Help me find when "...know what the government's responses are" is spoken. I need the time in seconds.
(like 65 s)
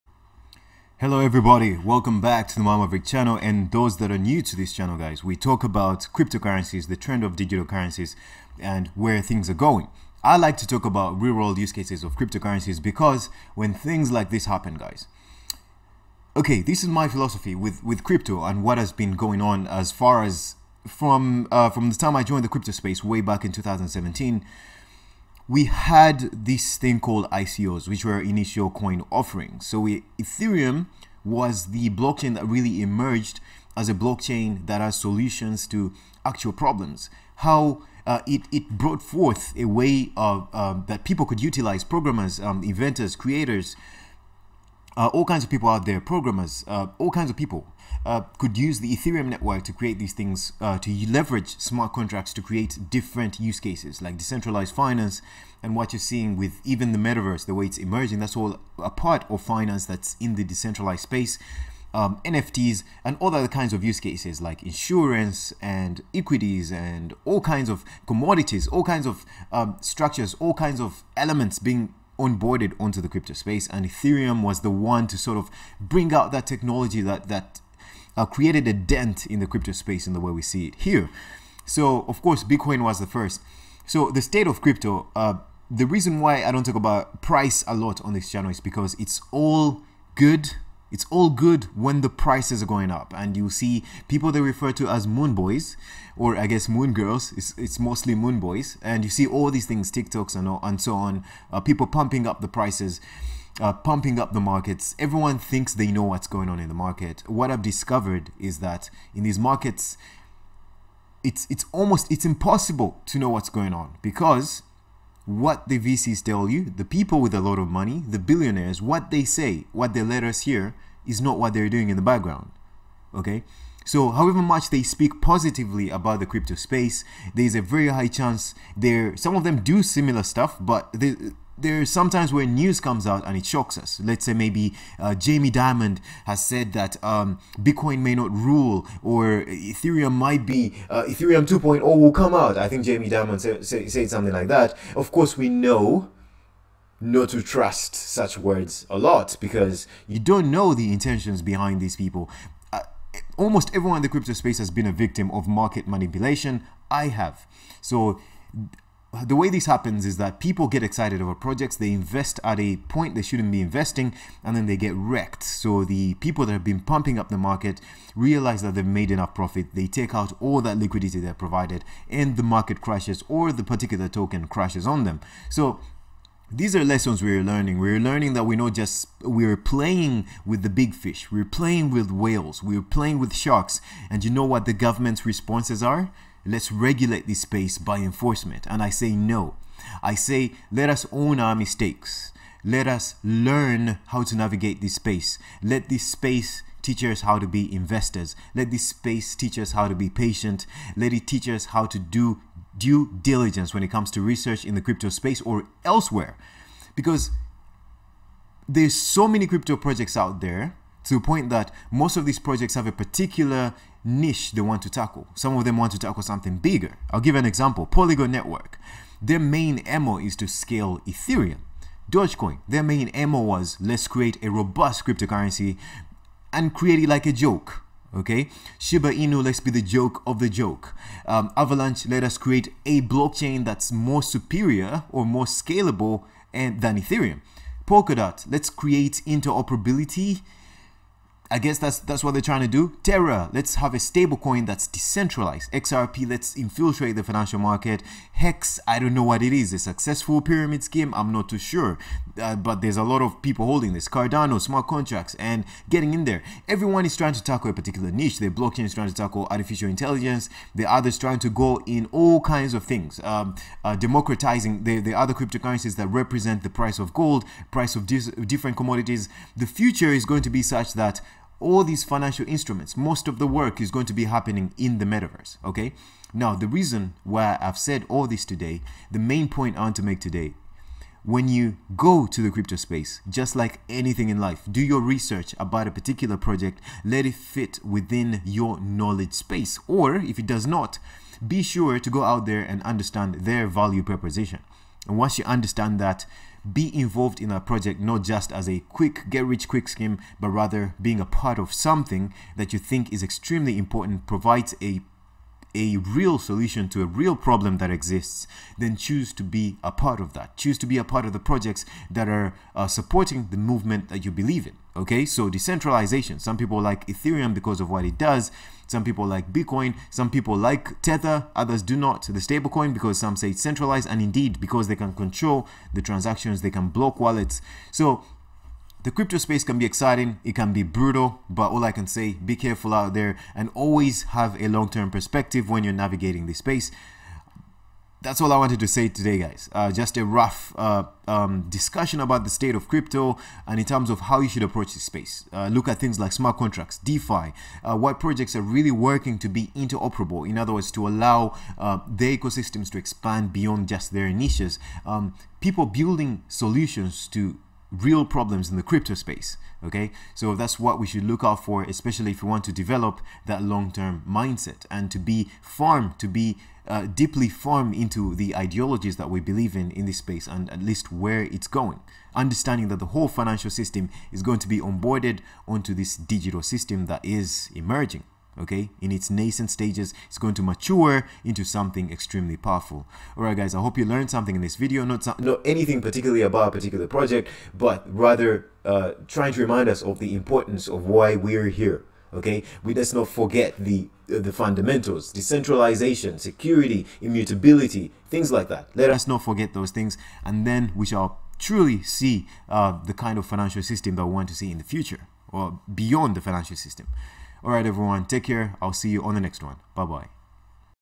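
184 s.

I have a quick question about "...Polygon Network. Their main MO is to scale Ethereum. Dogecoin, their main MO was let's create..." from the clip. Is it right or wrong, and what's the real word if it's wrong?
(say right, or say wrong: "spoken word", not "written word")
right.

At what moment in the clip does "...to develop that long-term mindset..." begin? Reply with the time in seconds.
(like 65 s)
362 s.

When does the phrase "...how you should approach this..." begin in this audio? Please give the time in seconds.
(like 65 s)
344 s.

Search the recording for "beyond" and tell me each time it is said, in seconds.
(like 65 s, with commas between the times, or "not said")
353 s, 405 s.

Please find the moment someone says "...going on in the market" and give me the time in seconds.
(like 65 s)
106 s.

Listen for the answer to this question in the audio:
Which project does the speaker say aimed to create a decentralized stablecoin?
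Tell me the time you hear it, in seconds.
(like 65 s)
243 s.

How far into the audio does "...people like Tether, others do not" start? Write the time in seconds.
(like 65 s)
320 s.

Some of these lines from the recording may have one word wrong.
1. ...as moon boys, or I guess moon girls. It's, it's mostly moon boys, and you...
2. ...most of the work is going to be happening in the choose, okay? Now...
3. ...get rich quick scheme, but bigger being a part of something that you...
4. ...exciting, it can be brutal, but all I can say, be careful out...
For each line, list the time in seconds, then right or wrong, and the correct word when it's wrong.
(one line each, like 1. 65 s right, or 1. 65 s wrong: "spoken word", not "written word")
1. 94 s right
2. 272 s wrong: "metaverse", not "choose"
3. 299 s wrong: "rather", not "bigger"
4. 329 s right.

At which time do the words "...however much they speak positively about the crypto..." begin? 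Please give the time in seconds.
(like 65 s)
124 s.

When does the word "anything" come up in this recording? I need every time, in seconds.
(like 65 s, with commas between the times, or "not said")
283 s, 385 s.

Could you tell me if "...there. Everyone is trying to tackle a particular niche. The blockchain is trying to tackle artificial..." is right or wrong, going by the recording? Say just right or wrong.
right.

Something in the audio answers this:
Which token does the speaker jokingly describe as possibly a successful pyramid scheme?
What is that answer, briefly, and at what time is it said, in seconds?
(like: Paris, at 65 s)
Hex, at 248 s.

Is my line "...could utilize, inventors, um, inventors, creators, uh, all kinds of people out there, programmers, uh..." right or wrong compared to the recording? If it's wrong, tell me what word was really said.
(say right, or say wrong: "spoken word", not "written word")
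wrong: "programmers", not "inventors".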